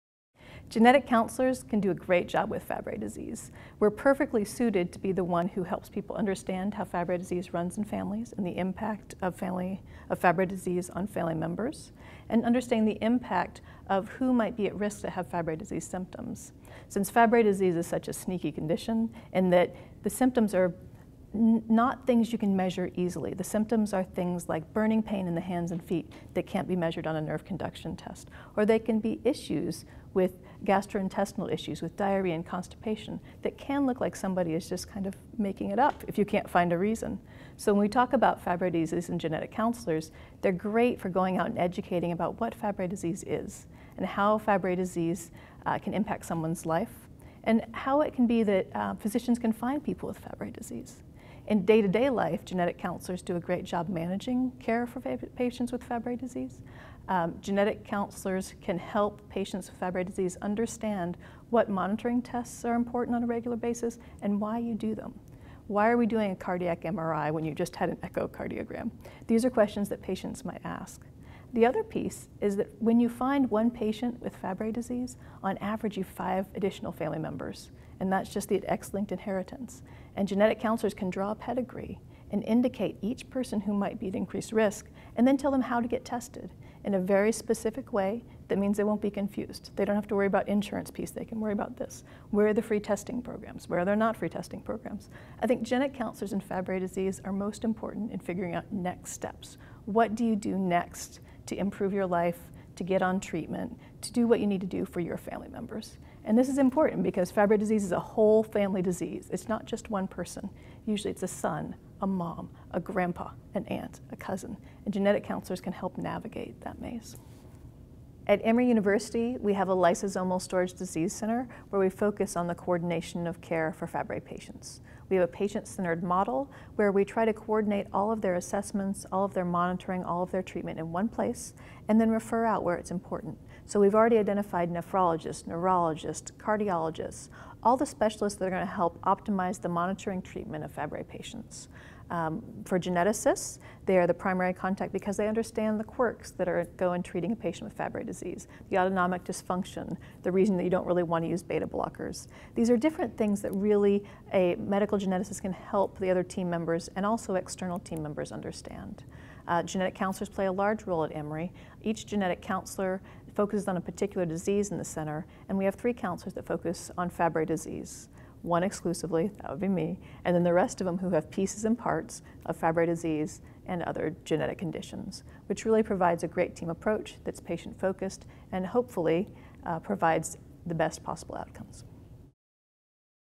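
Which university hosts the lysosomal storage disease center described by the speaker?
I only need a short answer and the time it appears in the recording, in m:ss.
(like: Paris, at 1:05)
Emory University, at 1:58.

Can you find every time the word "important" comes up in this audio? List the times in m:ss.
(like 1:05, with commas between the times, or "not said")
1:02, 1:37, 1:46, 2:12.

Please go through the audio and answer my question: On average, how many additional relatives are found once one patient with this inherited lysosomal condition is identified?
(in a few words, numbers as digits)
5.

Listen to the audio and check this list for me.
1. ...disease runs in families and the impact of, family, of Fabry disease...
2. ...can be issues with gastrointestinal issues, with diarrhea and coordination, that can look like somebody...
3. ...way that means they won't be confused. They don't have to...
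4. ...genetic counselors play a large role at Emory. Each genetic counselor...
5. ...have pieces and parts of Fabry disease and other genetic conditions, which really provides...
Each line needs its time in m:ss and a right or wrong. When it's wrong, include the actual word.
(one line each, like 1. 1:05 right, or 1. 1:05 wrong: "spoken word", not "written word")
1. 0:07 right
2. 0:28 wrong: "constipation", not "coordination"
3. 1:27 right
4. 2:39 right
5. 2:51 right.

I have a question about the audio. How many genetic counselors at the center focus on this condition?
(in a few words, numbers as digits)
3.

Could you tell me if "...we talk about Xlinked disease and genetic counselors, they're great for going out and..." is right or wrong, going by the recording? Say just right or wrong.
wrong.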